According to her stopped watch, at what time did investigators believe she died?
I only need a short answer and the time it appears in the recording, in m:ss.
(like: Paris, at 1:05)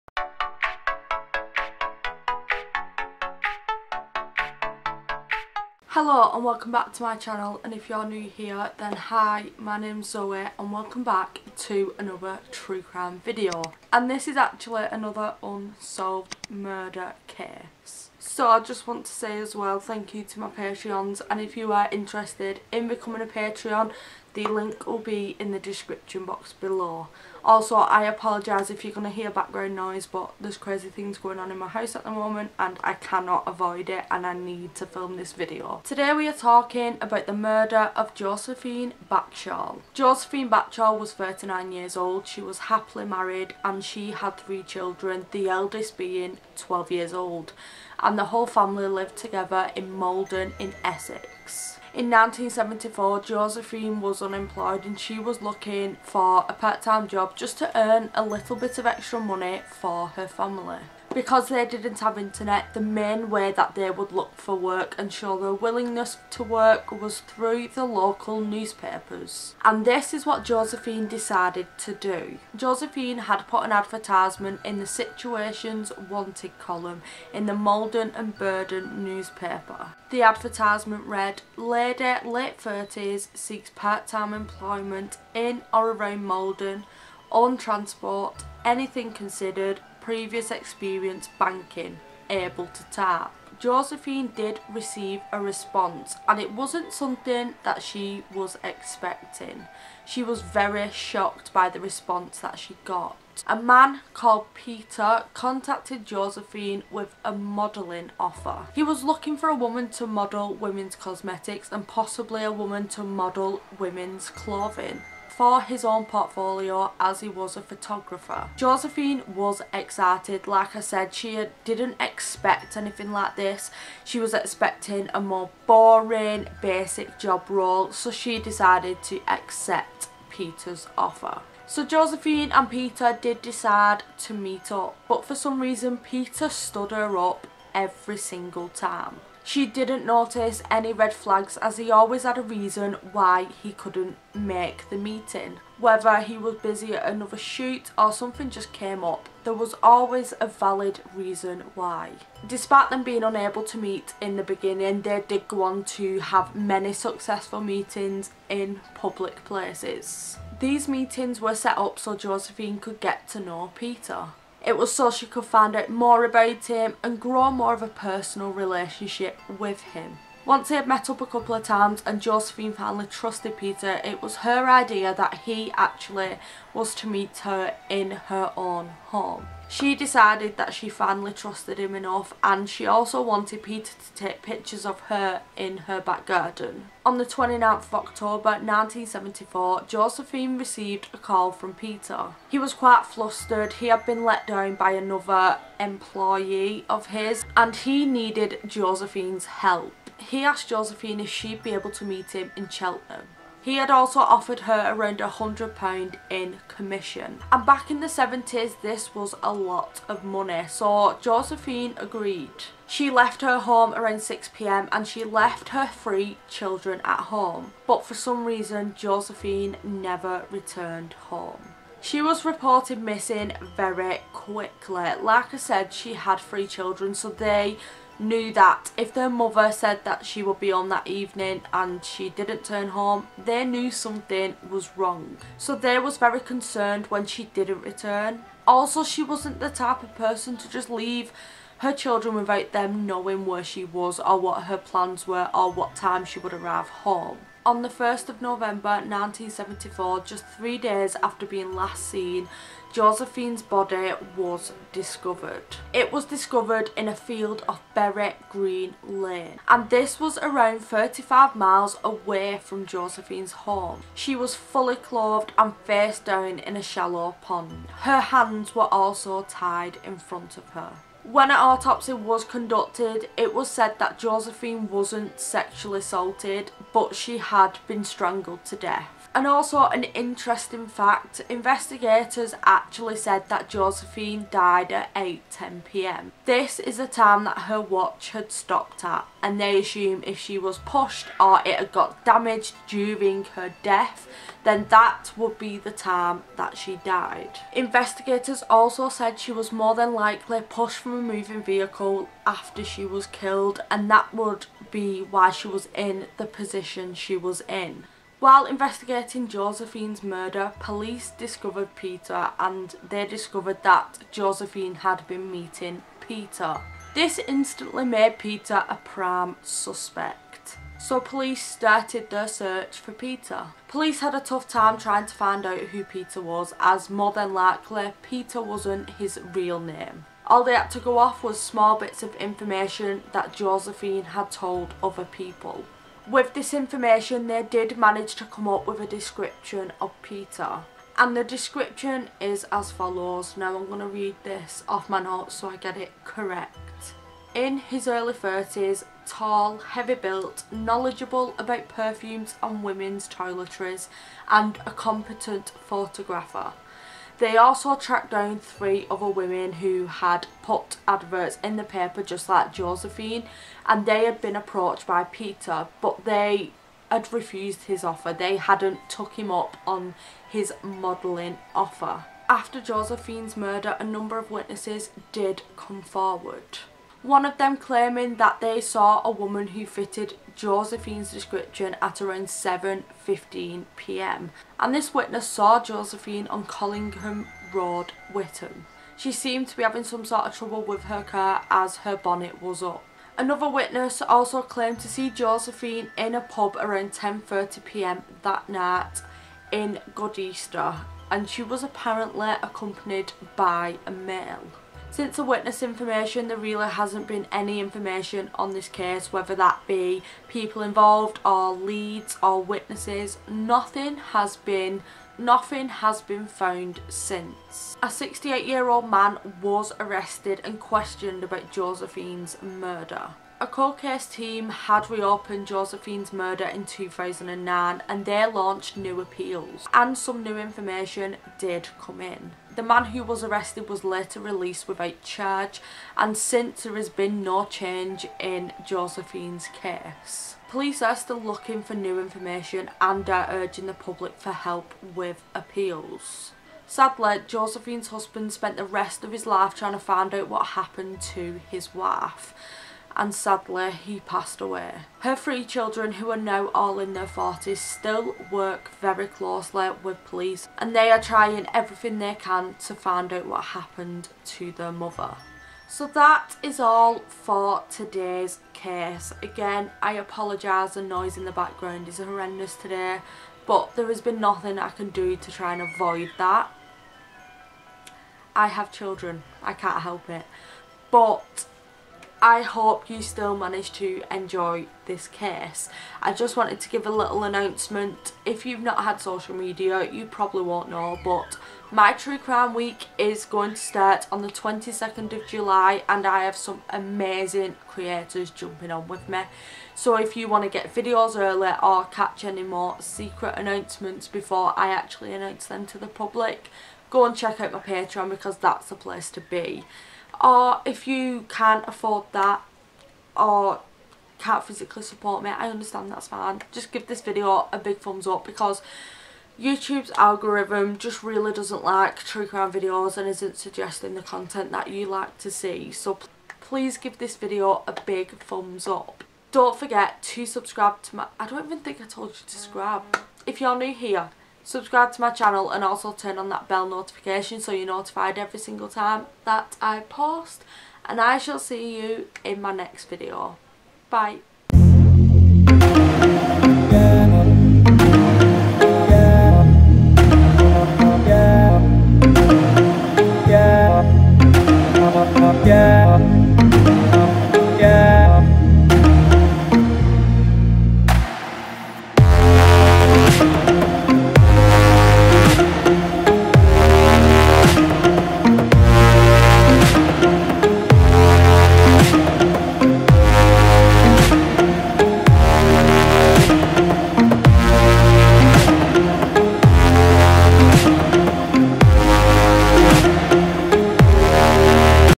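8.10pm, at 4:45.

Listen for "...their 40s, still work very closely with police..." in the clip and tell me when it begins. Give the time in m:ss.
7:37.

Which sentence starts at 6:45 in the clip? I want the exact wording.
Since the witness information, there really hasn't been any information on this case, whether that be people involved or leads or witnesses.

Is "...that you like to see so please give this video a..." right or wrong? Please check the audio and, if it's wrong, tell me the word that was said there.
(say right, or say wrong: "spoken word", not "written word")
right.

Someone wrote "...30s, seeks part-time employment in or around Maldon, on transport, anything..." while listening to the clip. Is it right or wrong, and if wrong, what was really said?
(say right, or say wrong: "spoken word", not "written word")
right.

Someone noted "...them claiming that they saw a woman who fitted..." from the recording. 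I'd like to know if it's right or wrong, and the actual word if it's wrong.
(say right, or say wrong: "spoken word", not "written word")
right.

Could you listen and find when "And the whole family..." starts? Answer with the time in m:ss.
0:48.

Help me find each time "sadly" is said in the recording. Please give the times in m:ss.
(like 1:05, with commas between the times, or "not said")
7:26, 7:33.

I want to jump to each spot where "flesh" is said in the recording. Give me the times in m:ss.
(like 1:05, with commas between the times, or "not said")
not said.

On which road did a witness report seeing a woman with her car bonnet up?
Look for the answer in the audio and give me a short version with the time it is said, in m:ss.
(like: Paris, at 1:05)
Collingham Road, at 6:26.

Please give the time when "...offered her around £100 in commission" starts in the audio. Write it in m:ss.
3:24.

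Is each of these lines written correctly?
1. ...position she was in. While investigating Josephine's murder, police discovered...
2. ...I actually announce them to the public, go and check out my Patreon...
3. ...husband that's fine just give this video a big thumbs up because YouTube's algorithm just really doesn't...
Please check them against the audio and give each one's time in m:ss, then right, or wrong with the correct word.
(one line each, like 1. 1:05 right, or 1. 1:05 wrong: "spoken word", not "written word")
1. 5:06 right
2. 8:24 right
3. 8:35 wrong: "understand", not "husband".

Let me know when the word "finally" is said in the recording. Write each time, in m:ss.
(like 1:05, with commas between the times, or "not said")
2:52, 3:00.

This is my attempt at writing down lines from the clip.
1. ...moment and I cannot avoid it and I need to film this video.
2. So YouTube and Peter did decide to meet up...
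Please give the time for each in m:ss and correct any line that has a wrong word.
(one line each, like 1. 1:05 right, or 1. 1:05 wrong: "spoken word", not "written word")
1. 0:32 right
2. 2:11 wrong: "Josephine", not "YouTube".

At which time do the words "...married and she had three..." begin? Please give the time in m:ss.
0:43.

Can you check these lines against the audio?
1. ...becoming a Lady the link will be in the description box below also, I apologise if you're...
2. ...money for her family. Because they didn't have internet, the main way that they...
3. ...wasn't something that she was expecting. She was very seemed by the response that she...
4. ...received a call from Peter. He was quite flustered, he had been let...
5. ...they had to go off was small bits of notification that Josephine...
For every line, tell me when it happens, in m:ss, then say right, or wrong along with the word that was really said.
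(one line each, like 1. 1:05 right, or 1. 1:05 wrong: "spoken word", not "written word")
1. 0:22 wrong: "Patreon", not "Lady"
2. 0:59 right
3. 1:36 wrong: "shocked", not "seemed"
4. 3:10 right
5. 5:30 wrong: "information", not "notification".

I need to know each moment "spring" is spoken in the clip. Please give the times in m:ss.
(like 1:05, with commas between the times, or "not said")
not said.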